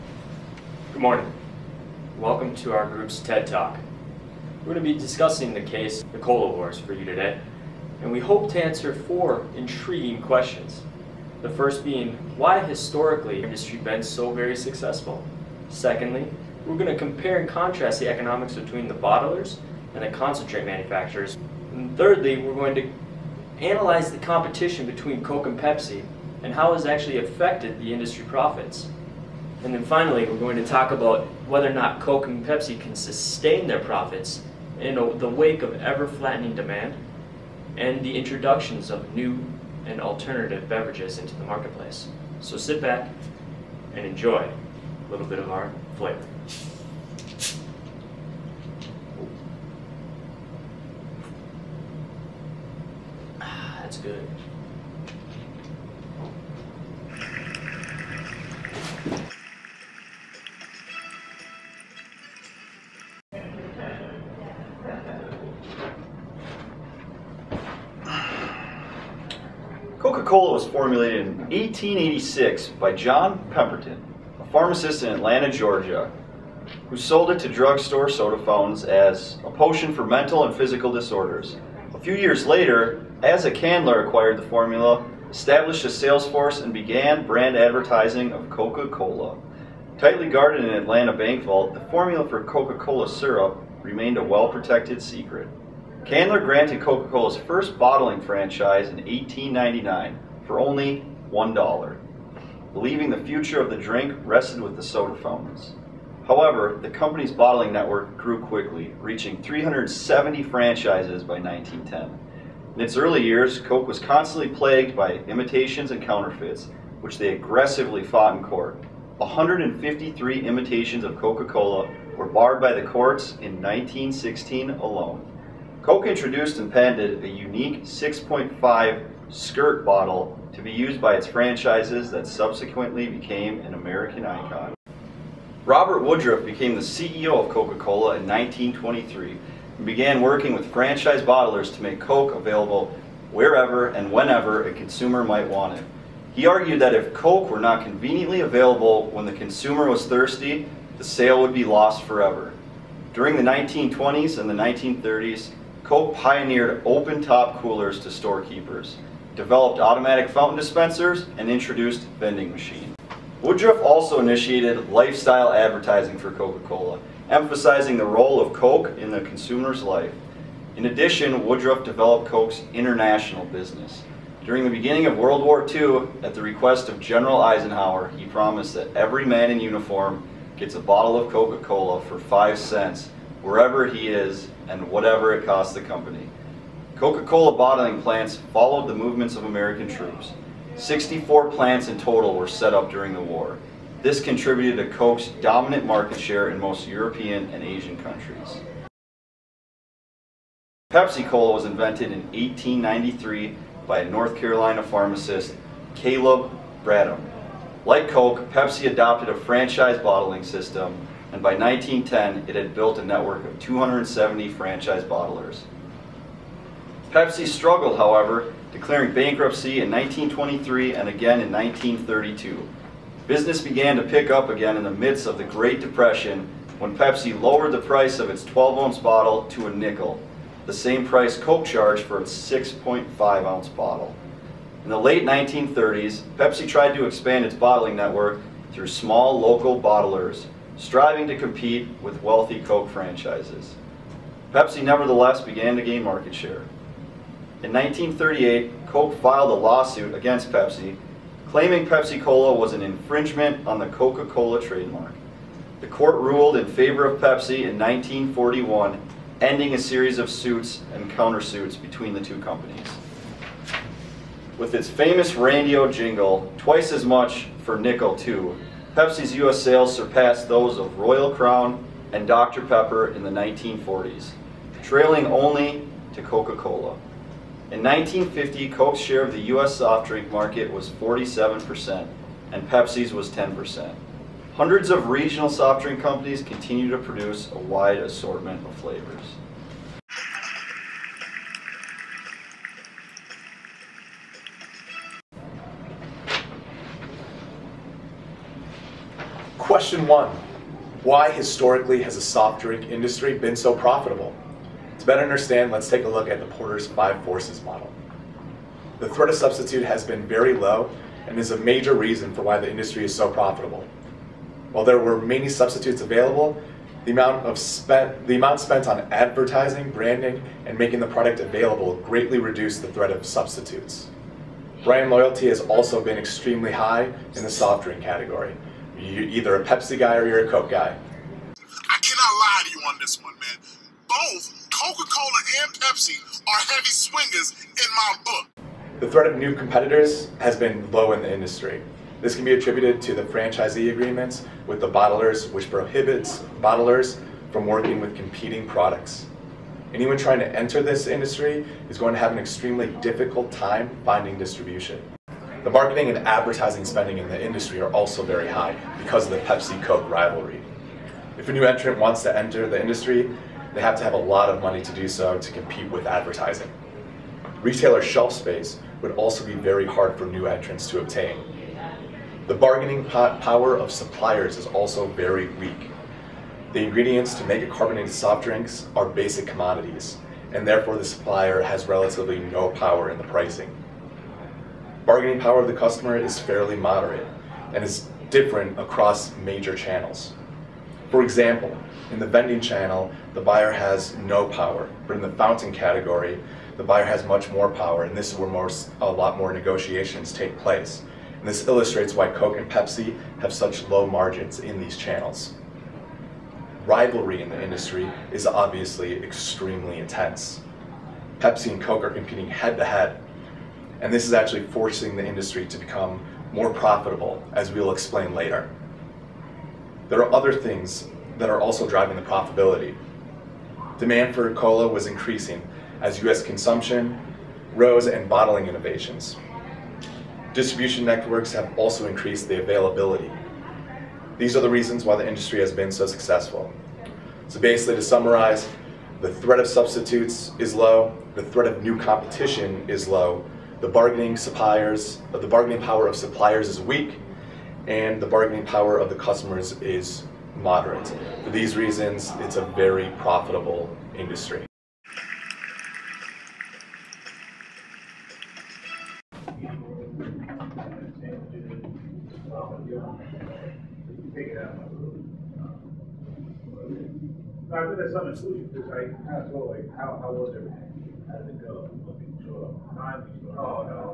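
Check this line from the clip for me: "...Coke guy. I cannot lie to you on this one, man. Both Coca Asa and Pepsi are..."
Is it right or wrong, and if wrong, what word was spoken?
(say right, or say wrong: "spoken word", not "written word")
wrong: "Cola", not "Asa".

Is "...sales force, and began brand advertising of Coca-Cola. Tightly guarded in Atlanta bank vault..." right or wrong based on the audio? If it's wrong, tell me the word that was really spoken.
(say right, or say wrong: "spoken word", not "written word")
right.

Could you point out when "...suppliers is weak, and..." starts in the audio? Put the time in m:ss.
7:26.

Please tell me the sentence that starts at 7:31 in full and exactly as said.
For these reasons, it's a very profitable industry.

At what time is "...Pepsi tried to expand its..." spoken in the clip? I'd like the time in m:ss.
3:56.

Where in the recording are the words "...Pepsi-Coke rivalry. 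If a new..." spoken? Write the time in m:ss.
5:59.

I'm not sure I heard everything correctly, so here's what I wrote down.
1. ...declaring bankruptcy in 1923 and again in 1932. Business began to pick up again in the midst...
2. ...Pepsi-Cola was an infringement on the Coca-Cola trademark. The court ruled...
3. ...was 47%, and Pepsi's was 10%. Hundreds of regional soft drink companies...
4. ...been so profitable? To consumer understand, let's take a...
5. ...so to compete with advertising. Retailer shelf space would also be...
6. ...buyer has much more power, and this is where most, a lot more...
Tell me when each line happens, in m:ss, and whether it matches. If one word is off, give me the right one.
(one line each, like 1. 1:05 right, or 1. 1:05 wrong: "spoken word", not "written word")
1. 3:38 right
2. 4:11 right
3. 4:40 right
4. 5:03 wrong: "better", not "consumer"
5. 6:05 right
6. 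6:36 right.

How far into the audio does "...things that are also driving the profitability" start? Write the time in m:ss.
7:00.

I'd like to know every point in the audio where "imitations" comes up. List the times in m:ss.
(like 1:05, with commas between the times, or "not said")
1:55, 2:00.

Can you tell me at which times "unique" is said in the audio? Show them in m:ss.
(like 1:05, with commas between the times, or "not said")
2:07.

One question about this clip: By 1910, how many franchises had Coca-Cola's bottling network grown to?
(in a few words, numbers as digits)
370.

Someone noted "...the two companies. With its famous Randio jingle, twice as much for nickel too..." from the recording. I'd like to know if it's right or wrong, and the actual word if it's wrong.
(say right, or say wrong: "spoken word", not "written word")
right.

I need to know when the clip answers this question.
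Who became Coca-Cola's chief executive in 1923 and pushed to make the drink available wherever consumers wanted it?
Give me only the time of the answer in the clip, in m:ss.
2:15.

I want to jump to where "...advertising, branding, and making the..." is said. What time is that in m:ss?
5:19.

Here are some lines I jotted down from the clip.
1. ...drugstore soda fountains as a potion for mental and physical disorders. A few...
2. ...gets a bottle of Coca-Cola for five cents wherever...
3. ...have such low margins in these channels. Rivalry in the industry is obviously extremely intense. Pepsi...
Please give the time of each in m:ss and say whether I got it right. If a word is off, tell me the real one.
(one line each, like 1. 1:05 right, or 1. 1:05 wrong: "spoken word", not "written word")
1. 1:17 right
2. 3:00 right
3. 6:43 right.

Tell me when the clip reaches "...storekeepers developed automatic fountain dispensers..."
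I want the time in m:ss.
2:38.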